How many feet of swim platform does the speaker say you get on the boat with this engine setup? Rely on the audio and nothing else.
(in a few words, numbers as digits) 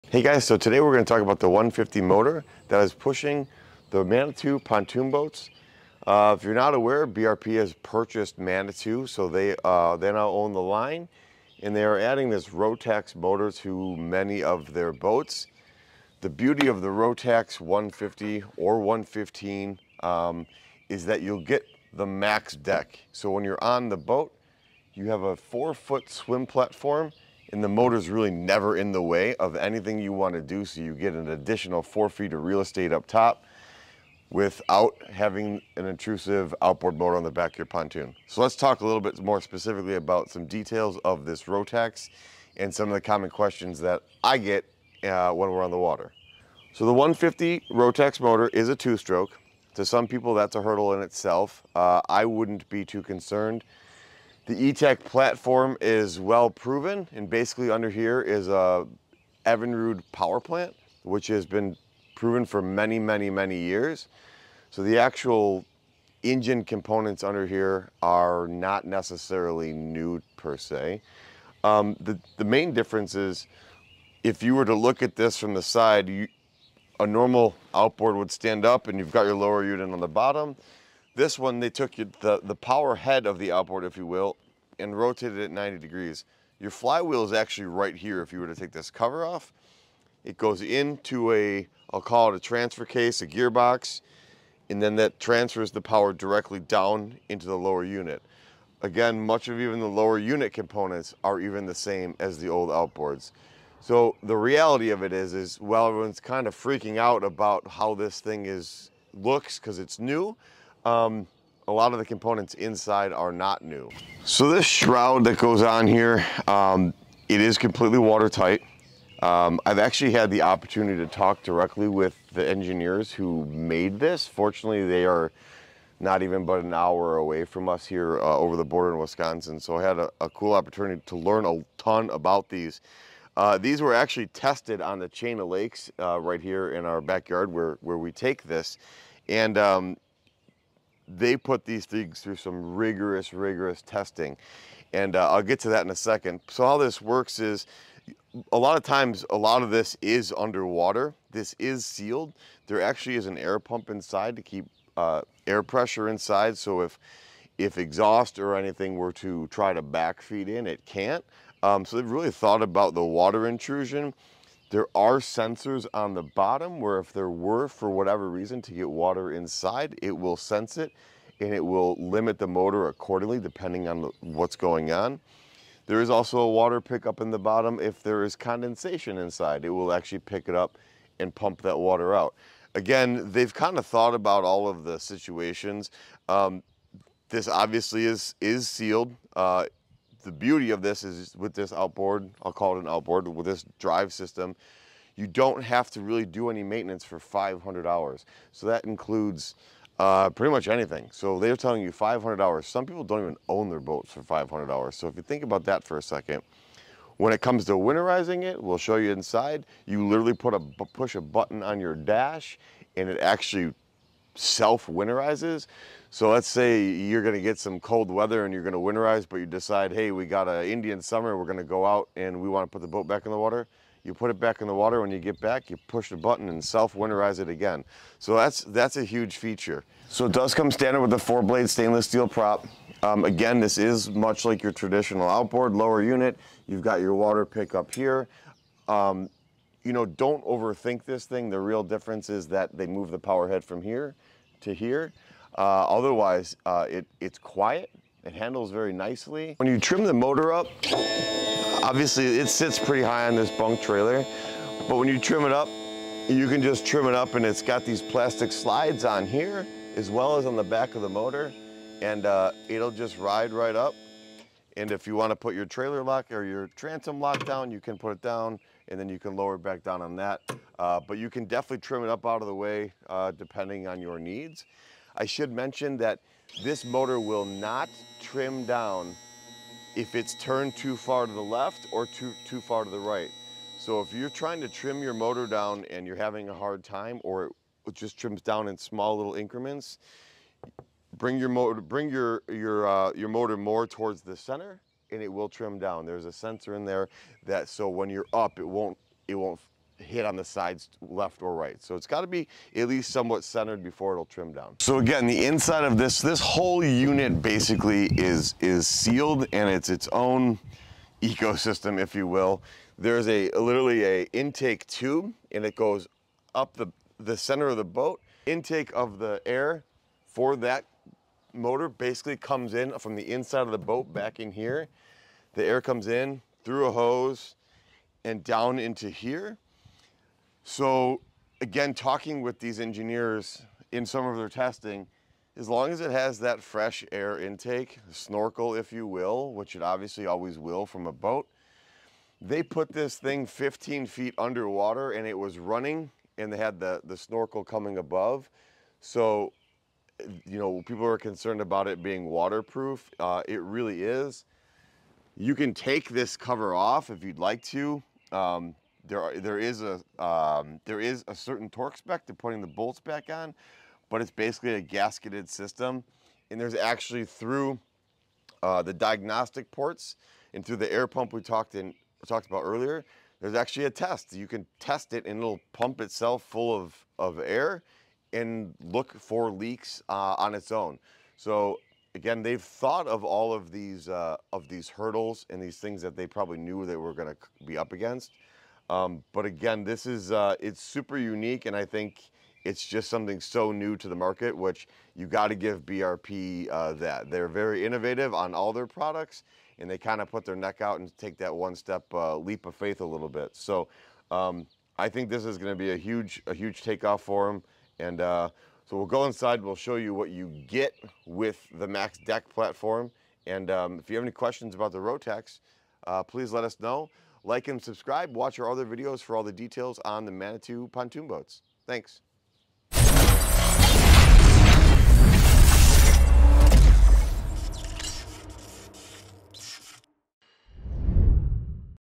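4.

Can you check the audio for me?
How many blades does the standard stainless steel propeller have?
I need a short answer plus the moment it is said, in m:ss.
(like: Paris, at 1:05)
4, at 3:51.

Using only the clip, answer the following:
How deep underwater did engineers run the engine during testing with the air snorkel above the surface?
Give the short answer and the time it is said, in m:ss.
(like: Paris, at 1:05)
15 feet, at 5:43.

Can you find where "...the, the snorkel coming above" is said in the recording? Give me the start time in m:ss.
5:46.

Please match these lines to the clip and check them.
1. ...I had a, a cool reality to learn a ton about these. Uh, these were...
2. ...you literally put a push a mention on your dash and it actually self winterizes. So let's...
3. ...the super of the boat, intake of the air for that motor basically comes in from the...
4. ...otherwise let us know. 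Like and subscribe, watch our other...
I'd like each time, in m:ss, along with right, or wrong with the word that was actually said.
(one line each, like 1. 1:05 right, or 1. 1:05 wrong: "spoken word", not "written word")
1. 2:09 wrong: "opportunity", not "reality"
2. 3:29 wrong: "button", not "mention"
3. 5:17 wrong: "center", not "super"
4. 6:56 wrong: "please", not "otherwise".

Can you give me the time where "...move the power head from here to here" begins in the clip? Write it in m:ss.
4:02.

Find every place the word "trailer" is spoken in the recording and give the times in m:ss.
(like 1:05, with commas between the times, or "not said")
4:13, 4:25.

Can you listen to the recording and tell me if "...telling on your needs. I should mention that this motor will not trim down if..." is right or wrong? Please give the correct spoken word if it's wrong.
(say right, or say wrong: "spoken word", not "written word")
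wrong: "depending", not "telling".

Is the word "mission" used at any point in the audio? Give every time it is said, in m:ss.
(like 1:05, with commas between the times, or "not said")
not said.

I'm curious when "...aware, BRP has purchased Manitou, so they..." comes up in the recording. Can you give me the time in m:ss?
0:06.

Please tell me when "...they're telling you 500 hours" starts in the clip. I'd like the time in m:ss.
3:21.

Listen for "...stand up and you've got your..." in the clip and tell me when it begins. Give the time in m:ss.
1:18.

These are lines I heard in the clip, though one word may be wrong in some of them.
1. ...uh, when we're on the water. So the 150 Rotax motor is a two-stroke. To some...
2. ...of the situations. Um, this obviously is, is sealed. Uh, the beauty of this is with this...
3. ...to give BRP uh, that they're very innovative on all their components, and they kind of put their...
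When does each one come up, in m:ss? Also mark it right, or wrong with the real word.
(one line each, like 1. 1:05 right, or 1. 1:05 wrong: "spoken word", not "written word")
1. 0:45 right
2. 3:04 right
3. 6:35 wrong: "products", not "components".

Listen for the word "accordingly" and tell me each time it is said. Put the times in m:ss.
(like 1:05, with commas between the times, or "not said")
2:52.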